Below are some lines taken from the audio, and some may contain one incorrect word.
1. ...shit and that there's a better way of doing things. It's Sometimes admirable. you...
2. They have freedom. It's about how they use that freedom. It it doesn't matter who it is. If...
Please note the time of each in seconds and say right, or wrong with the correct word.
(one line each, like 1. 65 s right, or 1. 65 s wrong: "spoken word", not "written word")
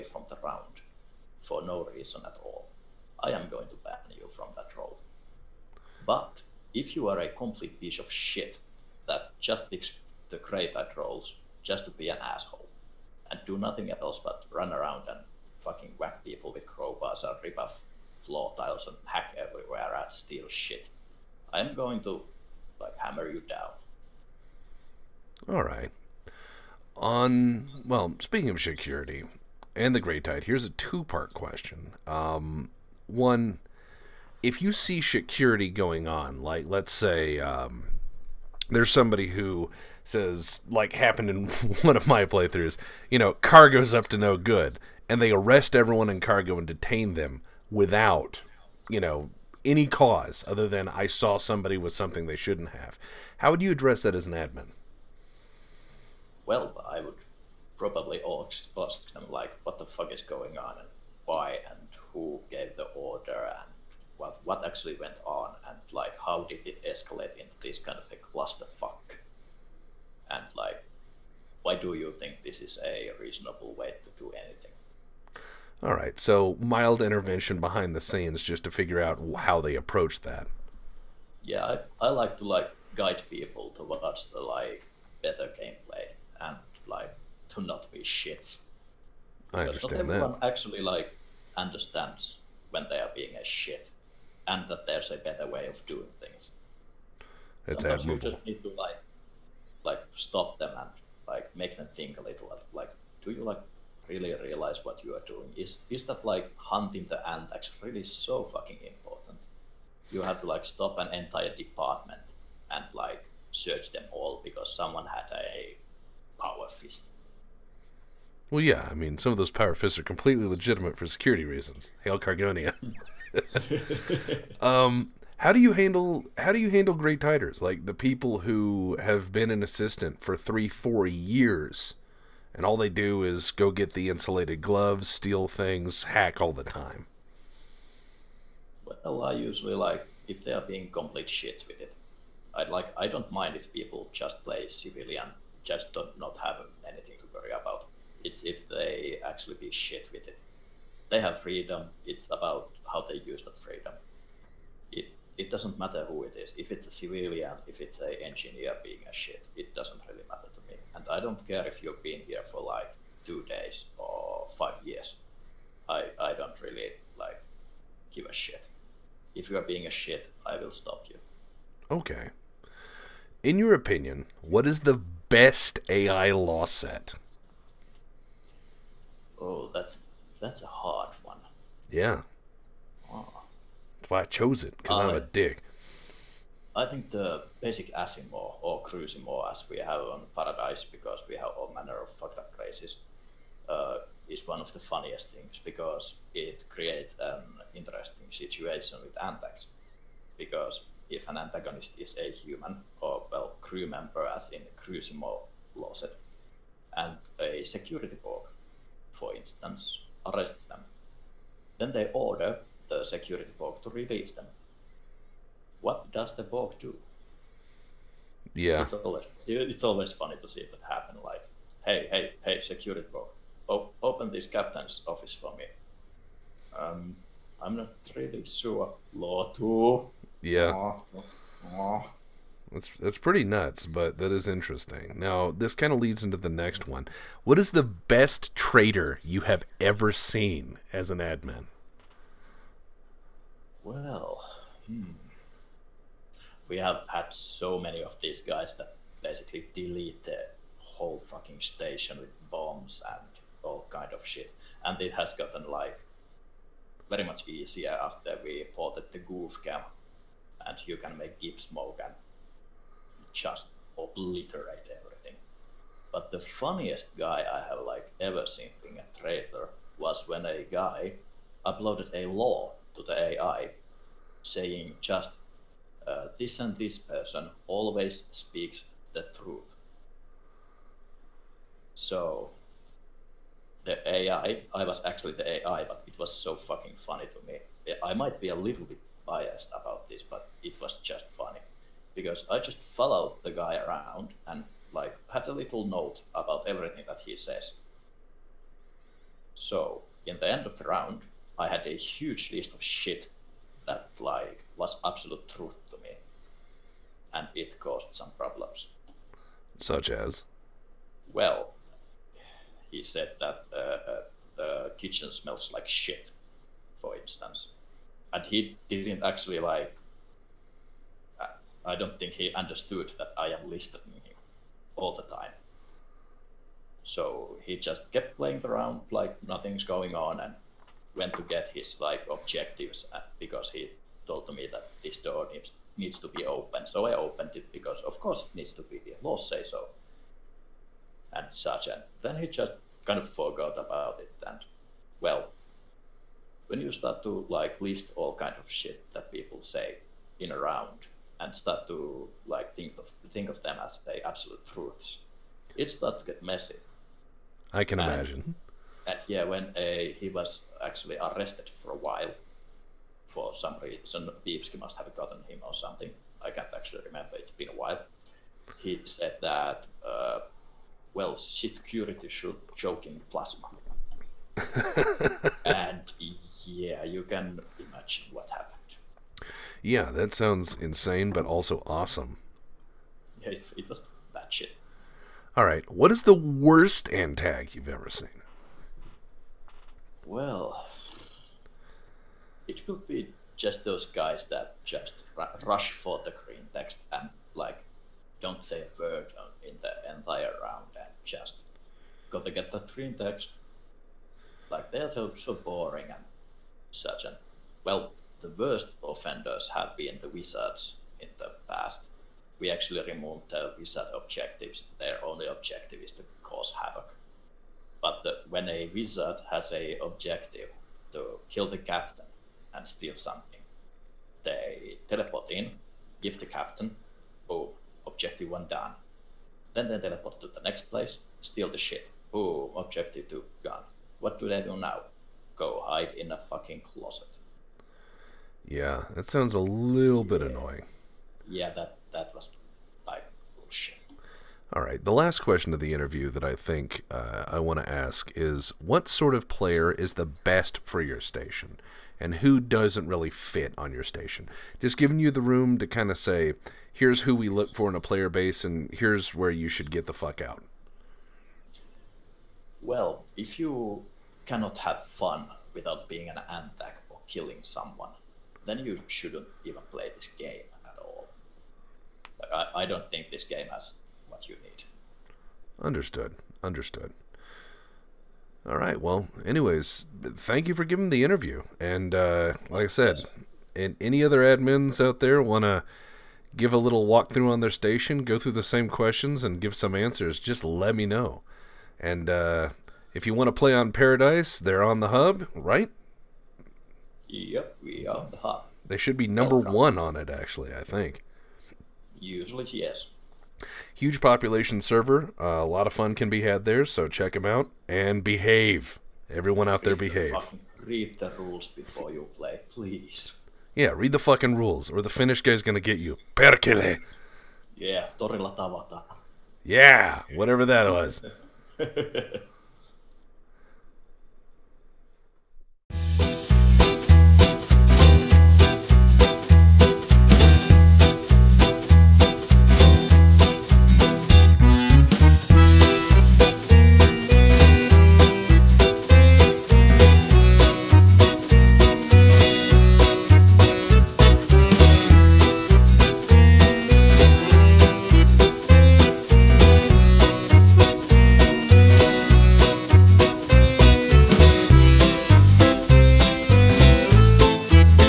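1. 93 s right
2. 151 s right.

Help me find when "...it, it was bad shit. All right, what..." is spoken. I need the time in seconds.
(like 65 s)
383 s.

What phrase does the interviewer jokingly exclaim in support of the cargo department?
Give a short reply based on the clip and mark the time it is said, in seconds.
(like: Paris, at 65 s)
Hail Cargonia, at 122 s.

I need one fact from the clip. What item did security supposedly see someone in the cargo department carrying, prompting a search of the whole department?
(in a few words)
power fist.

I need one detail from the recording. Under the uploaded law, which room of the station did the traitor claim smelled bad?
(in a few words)
the kitchen.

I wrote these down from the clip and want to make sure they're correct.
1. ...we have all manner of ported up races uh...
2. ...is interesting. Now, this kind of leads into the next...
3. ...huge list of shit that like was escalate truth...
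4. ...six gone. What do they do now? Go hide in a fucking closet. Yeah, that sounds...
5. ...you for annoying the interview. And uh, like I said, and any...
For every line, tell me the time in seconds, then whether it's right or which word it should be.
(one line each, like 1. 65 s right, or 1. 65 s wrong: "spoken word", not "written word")
1. 191 s wrong: "fucked", not "ported"
2. 234 s right
3. 301 s wrong: "absolute", not "escalate"
4. 433 s wrong: "two", not "six"
5. 480 s wrong: "giving", not "annoying".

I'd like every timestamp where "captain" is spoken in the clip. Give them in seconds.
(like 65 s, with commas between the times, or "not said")
224 s, 421 s, 426 s.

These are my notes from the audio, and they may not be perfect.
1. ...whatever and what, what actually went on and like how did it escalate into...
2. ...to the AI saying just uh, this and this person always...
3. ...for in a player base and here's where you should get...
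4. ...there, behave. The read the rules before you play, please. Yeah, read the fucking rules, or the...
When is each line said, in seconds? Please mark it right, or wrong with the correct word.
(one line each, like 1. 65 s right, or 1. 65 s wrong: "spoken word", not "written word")
1. 62 s wrong: "order", not "whatever"
2. 272 s right
3. 457 s right
4. 509 s right.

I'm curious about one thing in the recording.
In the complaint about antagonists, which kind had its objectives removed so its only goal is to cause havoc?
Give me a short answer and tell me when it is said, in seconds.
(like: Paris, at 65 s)
wizards, at 410 s.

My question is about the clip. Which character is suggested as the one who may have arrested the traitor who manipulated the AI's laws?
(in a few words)
Biebski.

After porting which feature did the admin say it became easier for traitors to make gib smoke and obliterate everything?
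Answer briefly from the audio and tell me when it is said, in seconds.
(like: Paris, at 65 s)
goof cam, at 259 s.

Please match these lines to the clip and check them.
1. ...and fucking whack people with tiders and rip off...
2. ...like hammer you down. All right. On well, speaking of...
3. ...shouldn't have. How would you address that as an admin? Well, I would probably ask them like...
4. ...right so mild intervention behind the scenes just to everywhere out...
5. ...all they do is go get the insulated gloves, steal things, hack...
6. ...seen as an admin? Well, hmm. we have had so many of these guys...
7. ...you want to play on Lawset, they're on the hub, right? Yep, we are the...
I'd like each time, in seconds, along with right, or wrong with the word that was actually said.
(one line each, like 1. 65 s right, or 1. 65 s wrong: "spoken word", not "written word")
1. 15 s wrong: "crowbars", not "tiders"
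2. 22 s right
3. 52 s right
4. 75 s wrong: "figure", not "everywhere"
5. 132 s right
6. 240 s right
7. 493 s wrong: "Paradise", not "Lawset".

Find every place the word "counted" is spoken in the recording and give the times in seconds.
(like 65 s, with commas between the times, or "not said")
not said.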